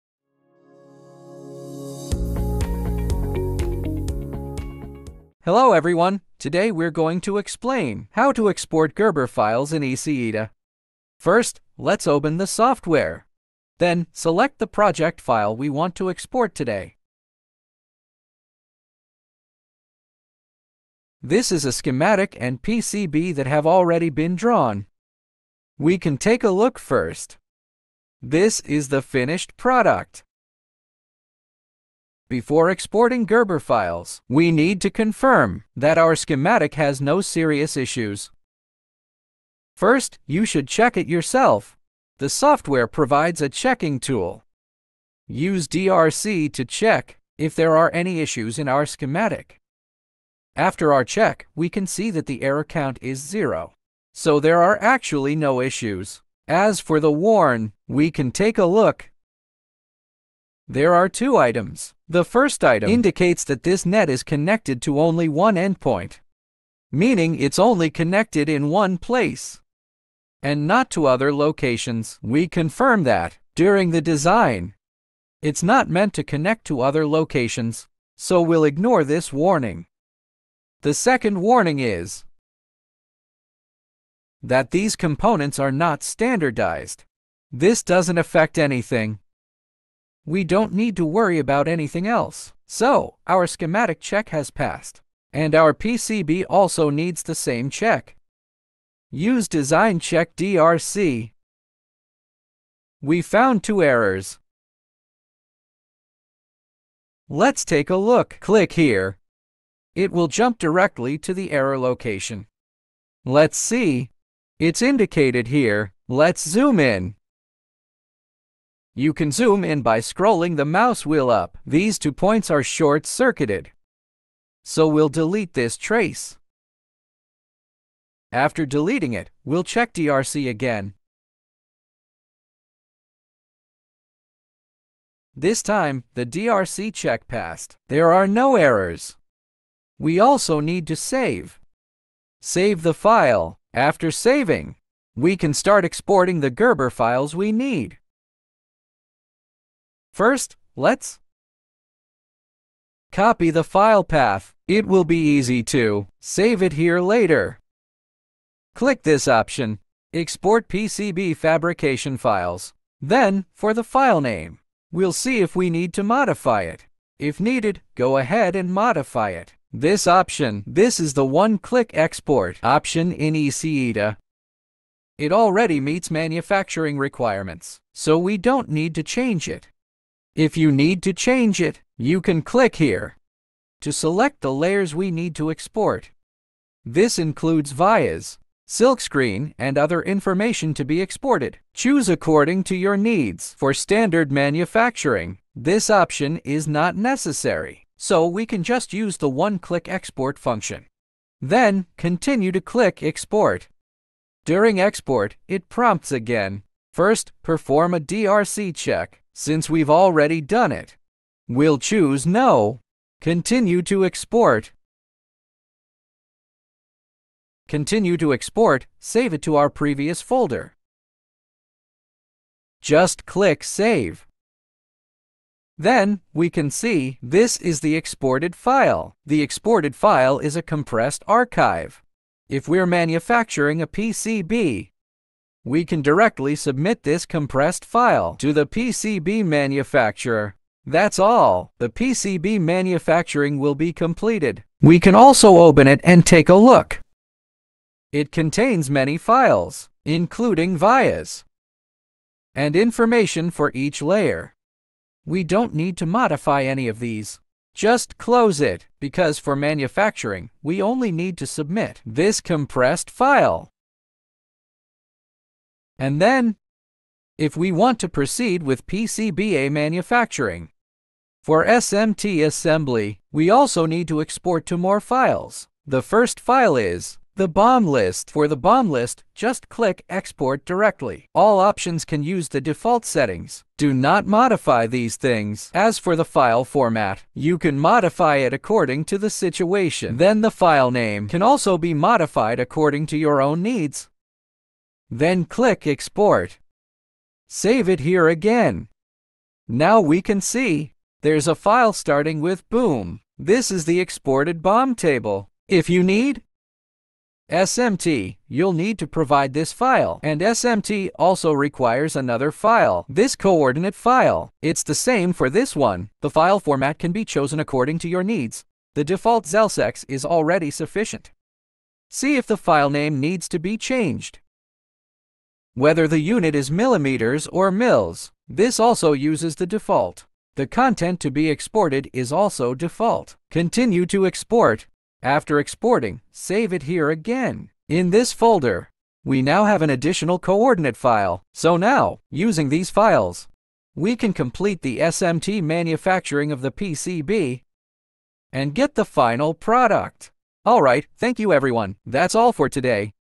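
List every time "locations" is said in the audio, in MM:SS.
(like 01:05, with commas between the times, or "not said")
01:11, 01:17, 01:51.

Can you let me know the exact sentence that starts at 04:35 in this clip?
The first file is the bom list.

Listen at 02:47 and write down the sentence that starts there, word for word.
If needed, go ahead and modify it.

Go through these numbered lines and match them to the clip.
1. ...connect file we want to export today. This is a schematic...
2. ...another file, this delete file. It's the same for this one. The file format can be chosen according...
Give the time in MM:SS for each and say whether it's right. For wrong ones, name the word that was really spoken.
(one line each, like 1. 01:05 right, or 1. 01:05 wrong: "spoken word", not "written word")
1. 00:14 wrong: "project", not "connect"
2. 05:12 wrong: "coordinate", not "delete".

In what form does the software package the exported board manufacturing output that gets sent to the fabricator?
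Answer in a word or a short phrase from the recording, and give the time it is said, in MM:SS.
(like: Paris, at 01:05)
Compressed archive, at 03:50.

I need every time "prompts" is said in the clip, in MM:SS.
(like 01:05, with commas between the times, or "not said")
03:25.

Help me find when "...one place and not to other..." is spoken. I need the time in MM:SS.
01:08.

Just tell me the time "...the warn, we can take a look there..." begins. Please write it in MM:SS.
00:57.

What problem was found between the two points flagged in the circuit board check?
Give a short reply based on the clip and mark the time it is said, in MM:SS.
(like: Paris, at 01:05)
Short-circuited, at 02:02.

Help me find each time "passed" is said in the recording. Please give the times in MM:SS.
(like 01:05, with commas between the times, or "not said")
01:34, 02:17.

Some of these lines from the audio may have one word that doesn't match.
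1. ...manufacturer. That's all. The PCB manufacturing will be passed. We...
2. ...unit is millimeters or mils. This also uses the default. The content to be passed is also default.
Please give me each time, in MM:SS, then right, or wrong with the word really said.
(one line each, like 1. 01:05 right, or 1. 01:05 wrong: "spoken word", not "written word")
1. 03:59 wrong: "completed", not "passed"
2. 05:26 wrong: "exported", not "passed".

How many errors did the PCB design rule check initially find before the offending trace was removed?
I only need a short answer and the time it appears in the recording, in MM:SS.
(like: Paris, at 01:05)
2, at 01:43.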